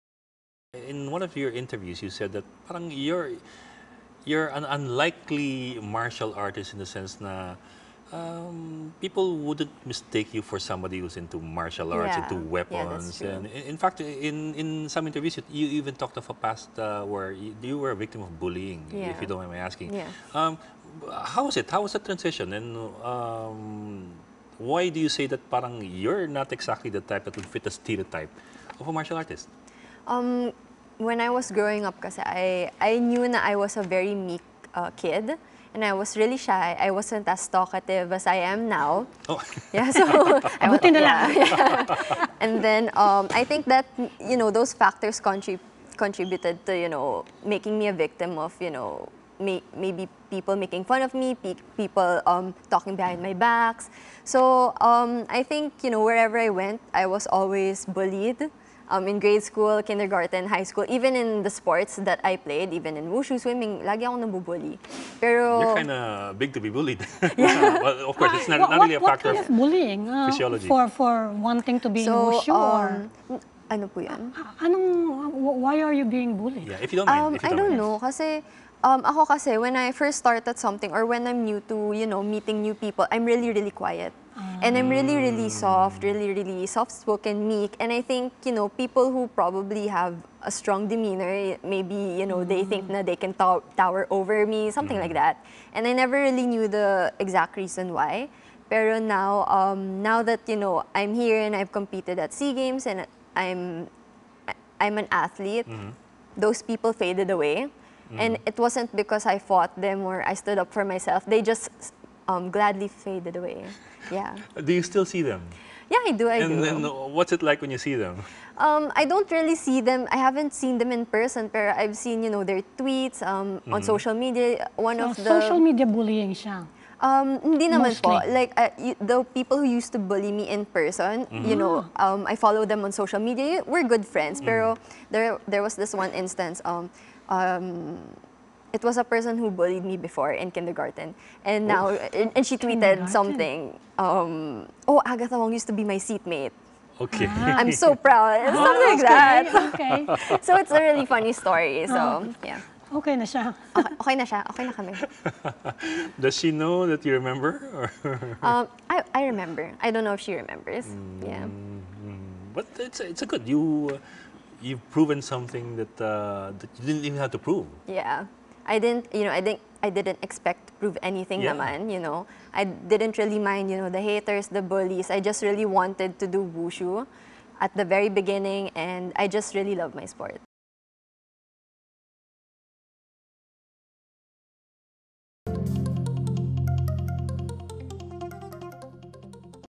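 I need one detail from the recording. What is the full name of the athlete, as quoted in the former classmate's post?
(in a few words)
Agatha Wong.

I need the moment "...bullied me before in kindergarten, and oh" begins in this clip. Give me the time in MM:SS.
02:19.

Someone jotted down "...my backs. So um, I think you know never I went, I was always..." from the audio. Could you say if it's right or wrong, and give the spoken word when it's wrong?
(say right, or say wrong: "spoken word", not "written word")
wrong: "wherever", not "never".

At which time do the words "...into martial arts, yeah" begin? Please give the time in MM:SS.
00:11.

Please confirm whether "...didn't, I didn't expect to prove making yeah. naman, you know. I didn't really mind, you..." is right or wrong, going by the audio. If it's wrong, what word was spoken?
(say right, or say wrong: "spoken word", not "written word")
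wrong: "anything", not "making".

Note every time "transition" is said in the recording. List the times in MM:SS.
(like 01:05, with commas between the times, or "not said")
00:21.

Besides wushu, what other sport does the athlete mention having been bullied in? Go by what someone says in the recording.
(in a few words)
Swimming.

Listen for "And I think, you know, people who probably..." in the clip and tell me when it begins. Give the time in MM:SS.
01:27.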